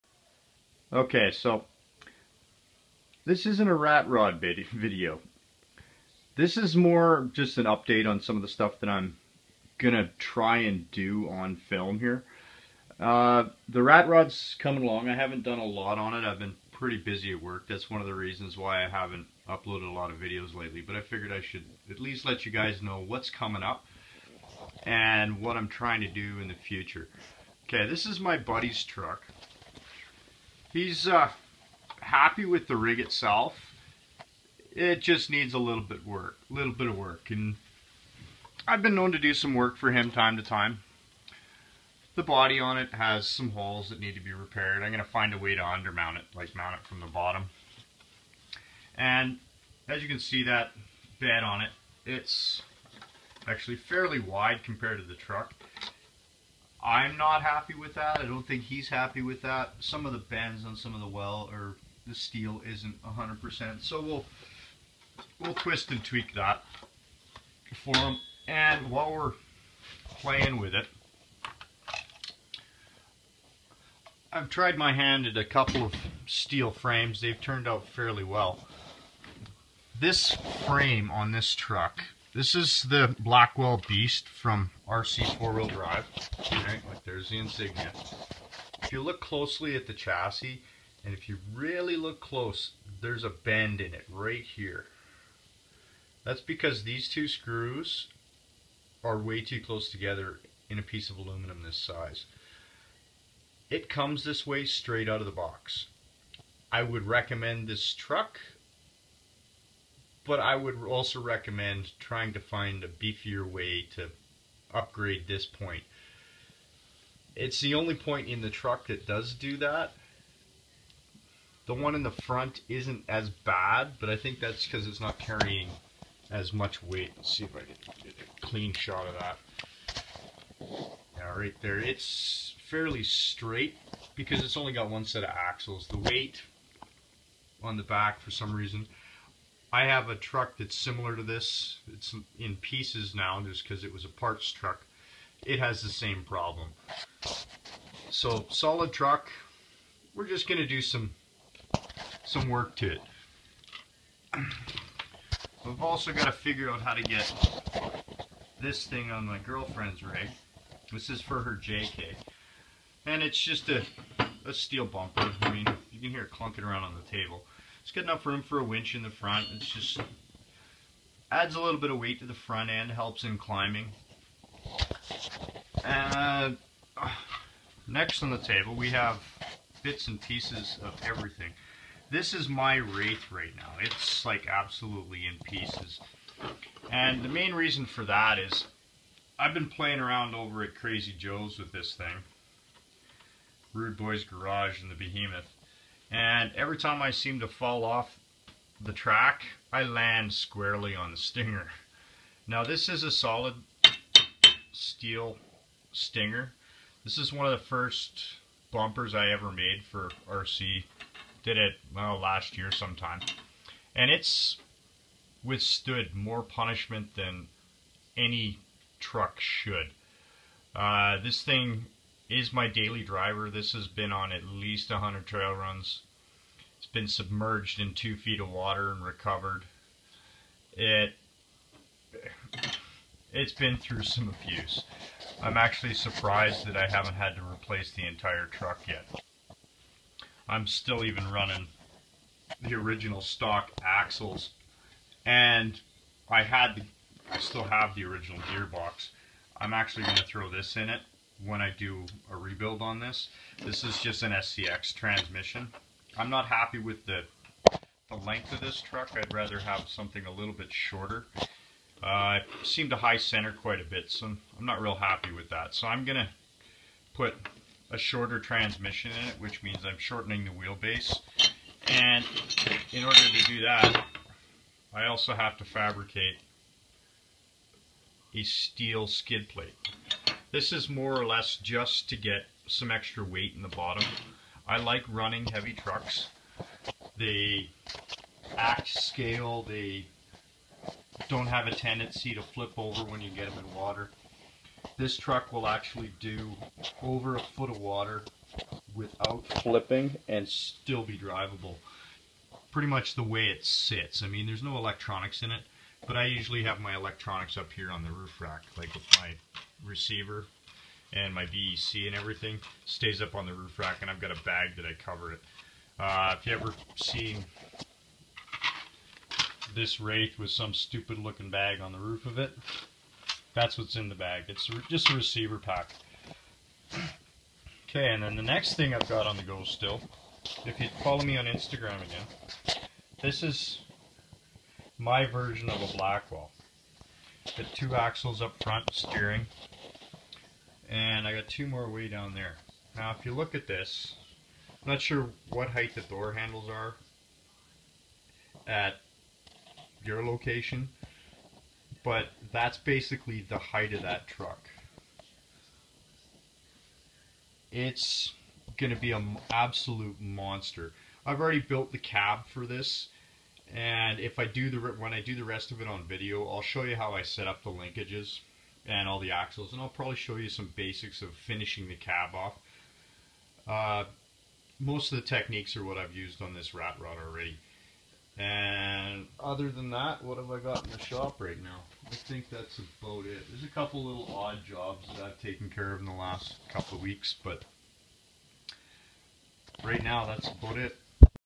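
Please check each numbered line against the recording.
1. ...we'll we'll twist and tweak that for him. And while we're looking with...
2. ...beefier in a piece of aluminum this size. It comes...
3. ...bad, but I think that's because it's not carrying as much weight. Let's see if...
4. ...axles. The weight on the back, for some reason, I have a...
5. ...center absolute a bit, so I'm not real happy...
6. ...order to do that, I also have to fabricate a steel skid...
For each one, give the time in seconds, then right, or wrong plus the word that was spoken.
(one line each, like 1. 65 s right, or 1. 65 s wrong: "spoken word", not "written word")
1. 64 s wrong: "playing", not "looking"
2. 99 s wrong: "together", not "beefier"
3. 123 s right
4. 135 s right
5. 263 s wrong: "quite", not "absolute"
6. 273 s right.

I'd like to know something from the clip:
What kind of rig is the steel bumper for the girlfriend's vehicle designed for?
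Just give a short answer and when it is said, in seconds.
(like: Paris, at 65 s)
JK, at 161 s.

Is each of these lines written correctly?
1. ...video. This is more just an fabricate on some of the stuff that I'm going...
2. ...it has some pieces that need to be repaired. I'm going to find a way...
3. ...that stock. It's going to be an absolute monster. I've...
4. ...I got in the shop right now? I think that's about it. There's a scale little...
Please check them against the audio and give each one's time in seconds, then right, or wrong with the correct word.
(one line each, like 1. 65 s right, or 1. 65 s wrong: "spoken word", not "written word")
1. 4 s wrong: "update", not "fabricate"
2. 42 s wrong: "holes", not "pieces"
3. 354 s wrong: "truck", not "stock"
4. 380 s wrong: "couple", not "scale".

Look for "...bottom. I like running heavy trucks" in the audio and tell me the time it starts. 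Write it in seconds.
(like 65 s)
283 s.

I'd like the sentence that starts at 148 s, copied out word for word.
So solid truck, we're just going to do some some work to it.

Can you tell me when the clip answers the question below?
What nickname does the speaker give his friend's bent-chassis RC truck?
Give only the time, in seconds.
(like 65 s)
83 s.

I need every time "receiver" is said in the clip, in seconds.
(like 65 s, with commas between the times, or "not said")
309 s, 325 s.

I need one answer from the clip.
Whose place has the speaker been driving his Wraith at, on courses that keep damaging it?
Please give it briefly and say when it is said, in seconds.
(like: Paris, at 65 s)
Crazy Joe's, at 190 s.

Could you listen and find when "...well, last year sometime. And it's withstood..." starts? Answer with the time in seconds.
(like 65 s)
211 s.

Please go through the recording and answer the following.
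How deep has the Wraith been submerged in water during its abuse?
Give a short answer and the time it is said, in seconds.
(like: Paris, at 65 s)
2 feet, at 227 s.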